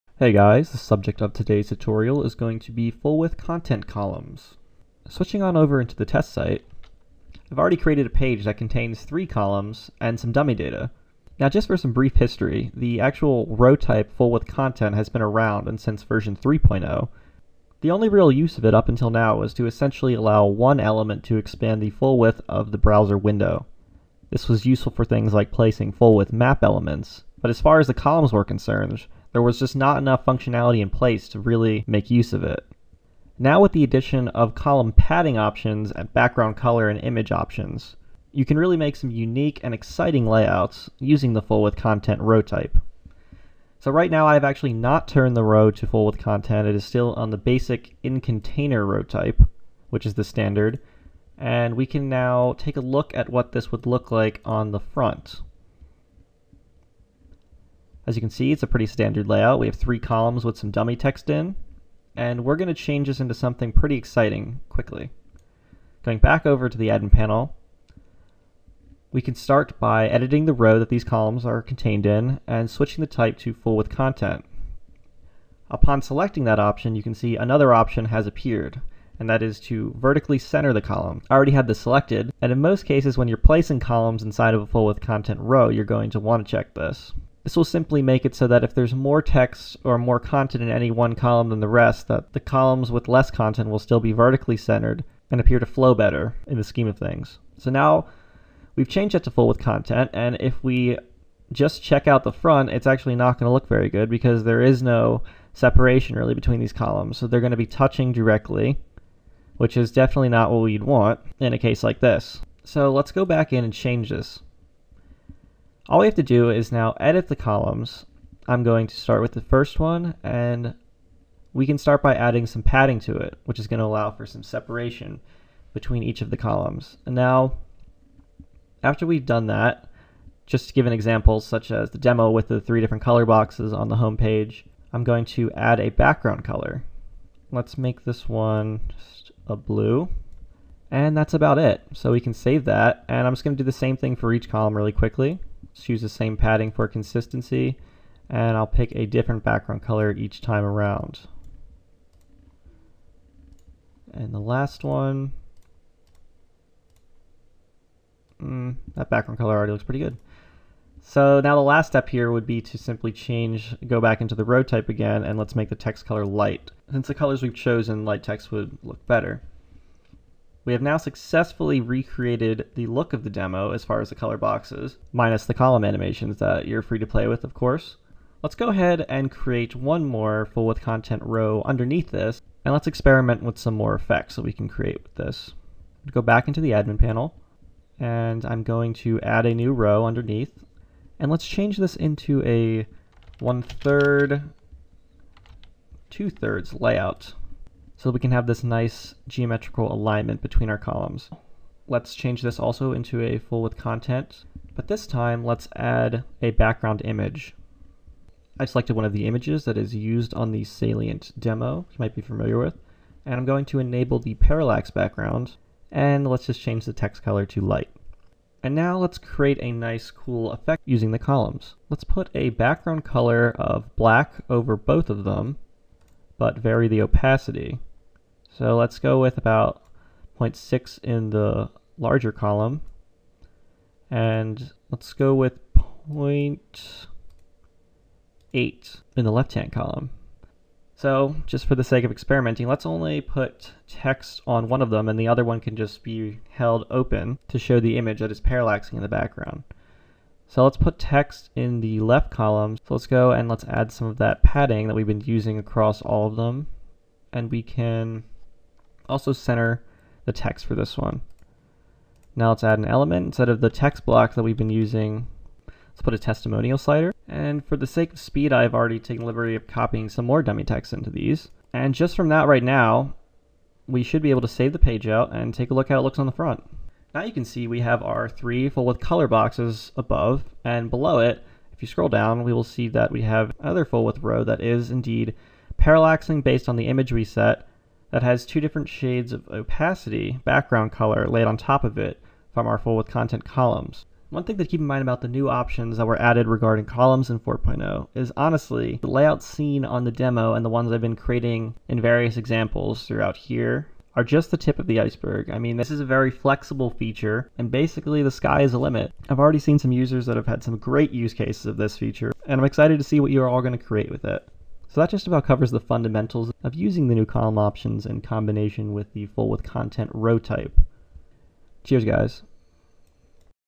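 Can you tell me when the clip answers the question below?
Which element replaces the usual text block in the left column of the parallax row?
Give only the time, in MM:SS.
04:26.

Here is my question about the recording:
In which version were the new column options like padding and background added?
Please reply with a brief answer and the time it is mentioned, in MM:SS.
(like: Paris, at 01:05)
4.0, at 04:57.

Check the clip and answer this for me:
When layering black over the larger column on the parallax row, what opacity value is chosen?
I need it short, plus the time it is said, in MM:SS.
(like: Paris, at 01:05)
0.6, at 03:50.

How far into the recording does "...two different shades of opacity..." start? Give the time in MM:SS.
04:48.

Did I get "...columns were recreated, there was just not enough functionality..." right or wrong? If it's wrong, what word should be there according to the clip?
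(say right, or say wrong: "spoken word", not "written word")
wrong: "concerned", not "recreated".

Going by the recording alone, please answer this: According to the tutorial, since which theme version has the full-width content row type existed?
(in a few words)
3.0.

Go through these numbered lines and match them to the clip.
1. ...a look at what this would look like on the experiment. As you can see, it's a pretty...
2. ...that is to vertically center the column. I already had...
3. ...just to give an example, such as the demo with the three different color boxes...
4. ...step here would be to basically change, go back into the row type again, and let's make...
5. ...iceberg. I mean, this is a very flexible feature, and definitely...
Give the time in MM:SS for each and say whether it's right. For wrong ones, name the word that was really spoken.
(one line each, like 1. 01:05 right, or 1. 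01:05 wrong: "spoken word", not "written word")
1. 00:52 wrong: "front", not "experiment"
2. 01:19 right
3. 02:10 right
4. 02:41 wrong: "simply", not "basically"
5. 05:04 wrong: "basically", not "definitely".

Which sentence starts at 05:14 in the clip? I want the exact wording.
So that just about covers the fundamentals of using the new column options in combination with the full width content row type.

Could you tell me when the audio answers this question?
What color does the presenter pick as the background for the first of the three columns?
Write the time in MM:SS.
02:19.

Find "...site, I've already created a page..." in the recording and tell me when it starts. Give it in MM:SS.
00:06.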